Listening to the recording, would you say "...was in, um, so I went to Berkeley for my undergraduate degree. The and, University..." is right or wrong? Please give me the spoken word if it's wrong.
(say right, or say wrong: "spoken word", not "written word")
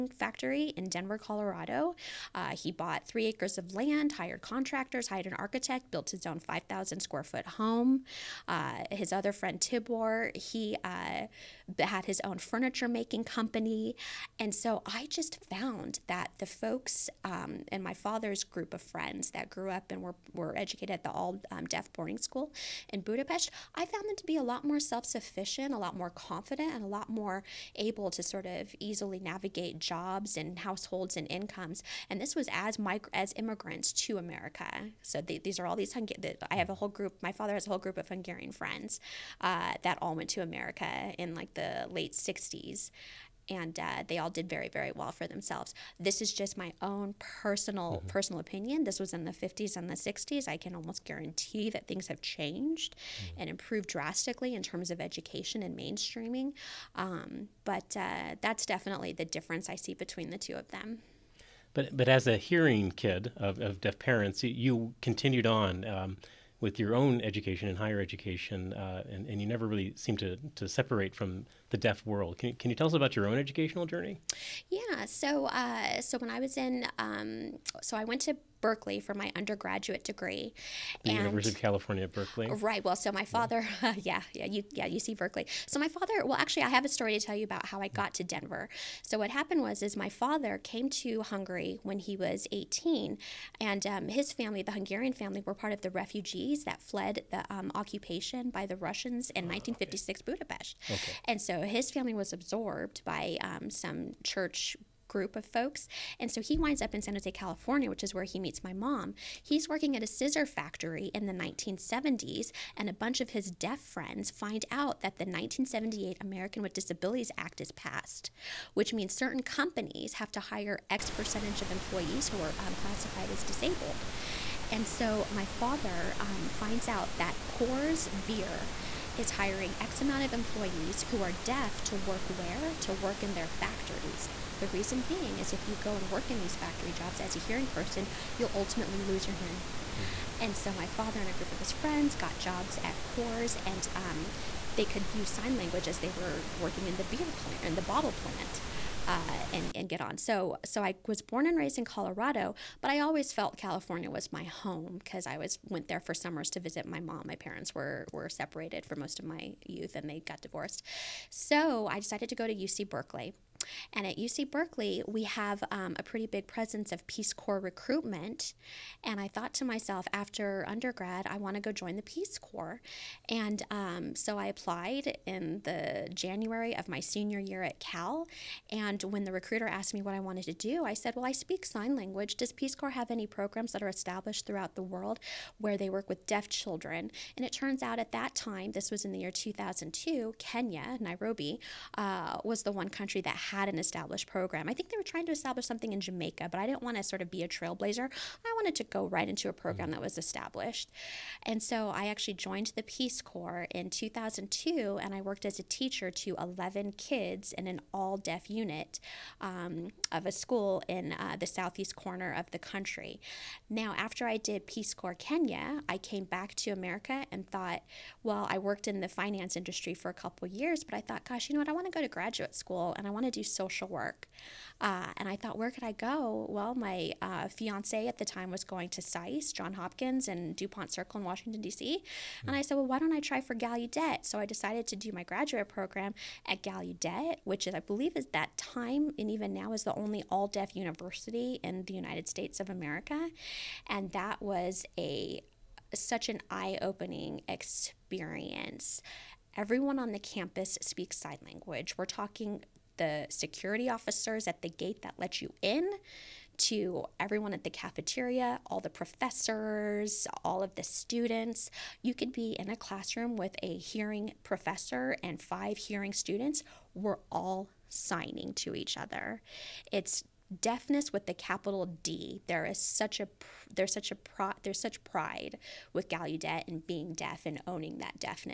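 right.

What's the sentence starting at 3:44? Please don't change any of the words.
Uh, and I thought, where could I go?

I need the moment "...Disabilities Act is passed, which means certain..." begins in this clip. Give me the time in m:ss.
1:56.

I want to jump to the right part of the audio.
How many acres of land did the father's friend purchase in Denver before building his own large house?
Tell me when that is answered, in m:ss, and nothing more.
0:03.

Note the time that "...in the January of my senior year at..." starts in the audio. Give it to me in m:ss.
2:55.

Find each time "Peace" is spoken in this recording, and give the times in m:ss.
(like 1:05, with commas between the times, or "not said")
2:47, 2:52, 3:02, 3:22, 3:34.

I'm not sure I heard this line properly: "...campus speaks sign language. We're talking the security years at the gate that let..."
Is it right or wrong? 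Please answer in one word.
wrong.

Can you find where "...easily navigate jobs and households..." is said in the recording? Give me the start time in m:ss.
0:28.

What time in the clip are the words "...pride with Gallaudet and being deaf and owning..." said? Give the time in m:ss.
4:35.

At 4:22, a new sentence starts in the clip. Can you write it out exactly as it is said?
You could be in a classroom with a hearing professor and five hearing students.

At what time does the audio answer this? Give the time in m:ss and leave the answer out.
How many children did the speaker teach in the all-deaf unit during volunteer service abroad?
3:26.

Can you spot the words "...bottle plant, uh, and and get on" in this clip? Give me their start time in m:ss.
2:27.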